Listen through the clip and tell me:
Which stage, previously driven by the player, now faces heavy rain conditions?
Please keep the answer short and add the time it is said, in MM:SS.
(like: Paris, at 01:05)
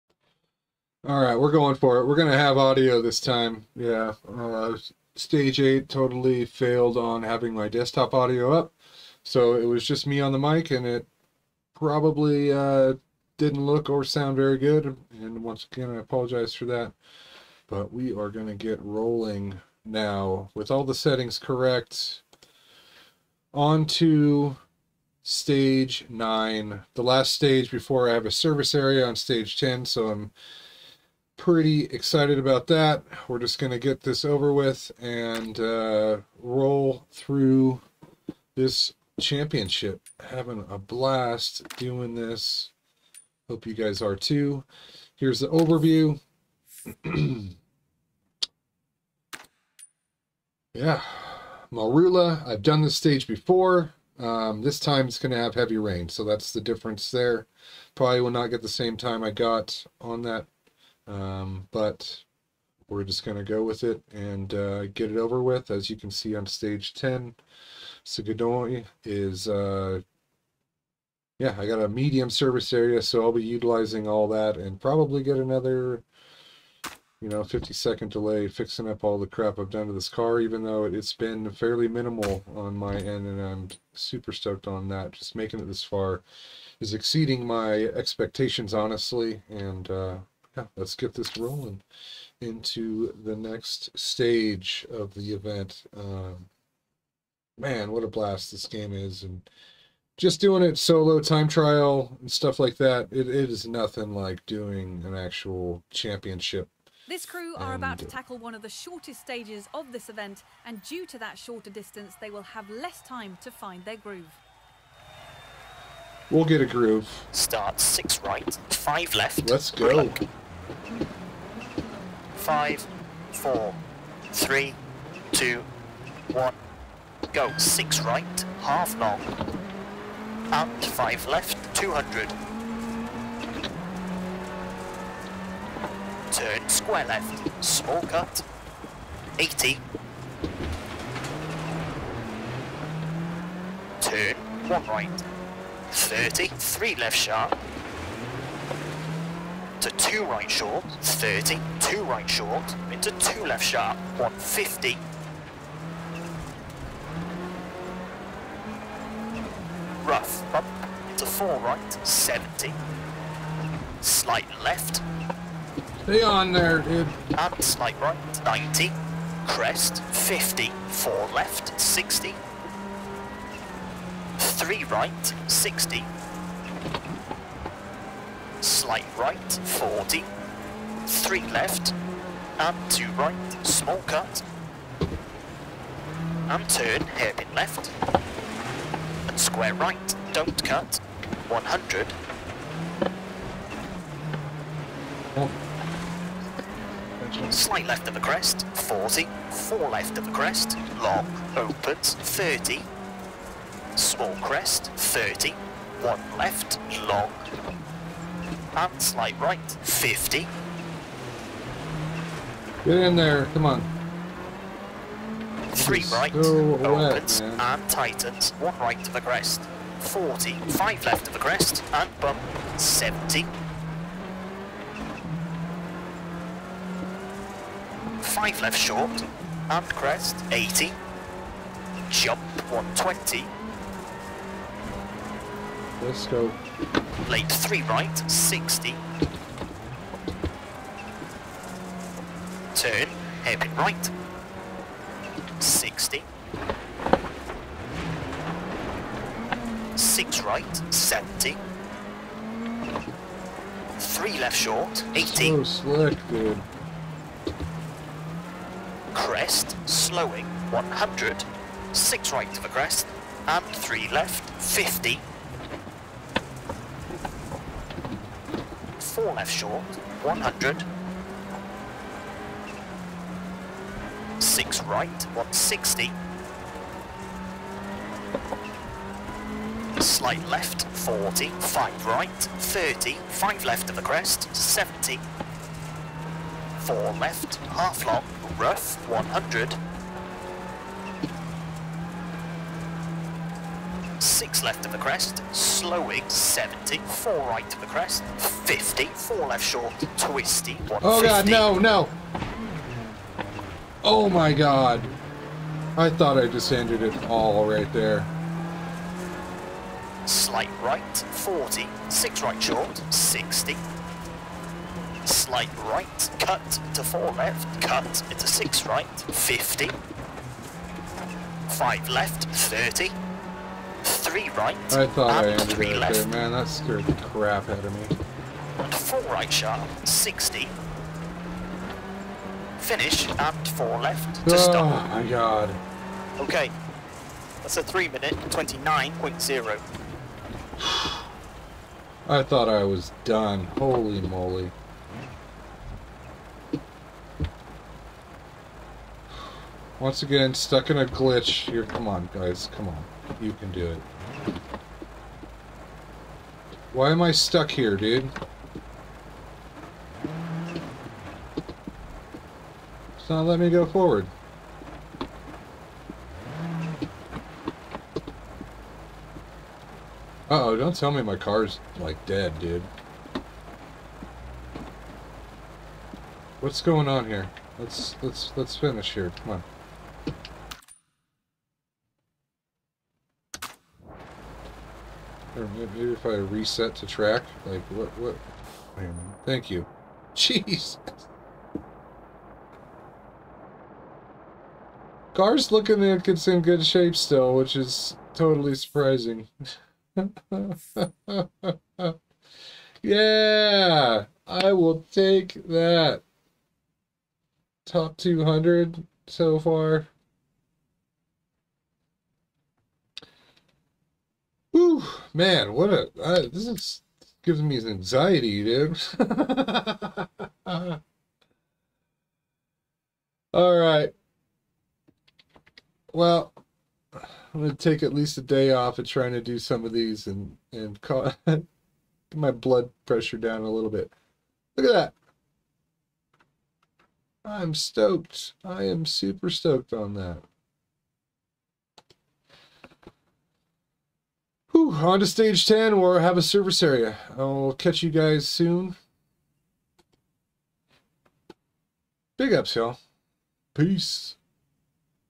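Marula, at 00:51.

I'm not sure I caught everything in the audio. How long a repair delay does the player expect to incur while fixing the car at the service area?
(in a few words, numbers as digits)
50 seconds.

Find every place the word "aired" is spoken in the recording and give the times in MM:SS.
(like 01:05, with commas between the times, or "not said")
not said.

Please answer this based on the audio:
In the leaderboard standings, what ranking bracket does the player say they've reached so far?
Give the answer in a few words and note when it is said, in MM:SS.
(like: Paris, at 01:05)
Top 200, at 06:47.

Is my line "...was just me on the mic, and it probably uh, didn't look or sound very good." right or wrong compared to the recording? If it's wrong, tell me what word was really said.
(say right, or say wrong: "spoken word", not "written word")
right.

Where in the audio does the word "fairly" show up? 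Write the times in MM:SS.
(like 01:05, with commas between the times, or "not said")
01:21.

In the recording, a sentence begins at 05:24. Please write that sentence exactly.
I thought and I ended three left.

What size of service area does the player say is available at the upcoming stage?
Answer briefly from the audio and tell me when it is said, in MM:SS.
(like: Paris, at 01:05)
Medium, at 01:11.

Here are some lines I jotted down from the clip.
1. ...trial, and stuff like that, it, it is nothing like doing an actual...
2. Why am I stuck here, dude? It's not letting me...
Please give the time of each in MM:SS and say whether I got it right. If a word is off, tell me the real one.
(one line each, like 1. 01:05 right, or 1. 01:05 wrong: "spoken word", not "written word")
1. 01:41 right
2. 05:56 right.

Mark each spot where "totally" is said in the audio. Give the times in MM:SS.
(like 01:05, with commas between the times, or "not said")
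00:05, 06:38.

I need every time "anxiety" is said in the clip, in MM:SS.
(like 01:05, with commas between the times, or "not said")
06:57.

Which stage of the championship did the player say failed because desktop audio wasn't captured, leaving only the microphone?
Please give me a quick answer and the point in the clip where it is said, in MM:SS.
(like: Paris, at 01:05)
Stage 8, at 00:05.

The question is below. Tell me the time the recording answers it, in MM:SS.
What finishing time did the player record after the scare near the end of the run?
05:37.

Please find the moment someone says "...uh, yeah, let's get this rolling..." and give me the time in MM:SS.
01:29.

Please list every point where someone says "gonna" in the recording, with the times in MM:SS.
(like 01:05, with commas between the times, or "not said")
07:07.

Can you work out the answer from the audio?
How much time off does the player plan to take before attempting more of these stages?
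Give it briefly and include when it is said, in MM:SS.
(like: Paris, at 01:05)
At least a day, at 07:08.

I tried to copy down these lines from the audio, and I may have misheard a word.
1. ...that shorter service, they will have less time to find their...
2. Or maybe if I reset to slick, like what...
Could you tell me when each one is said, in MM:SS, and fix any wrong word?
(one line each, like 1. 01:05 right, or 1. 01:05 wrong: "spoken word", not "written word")
1. 01:51 wrong: "distance", not "service"
2. 06:25 wrong: "track", not "slick".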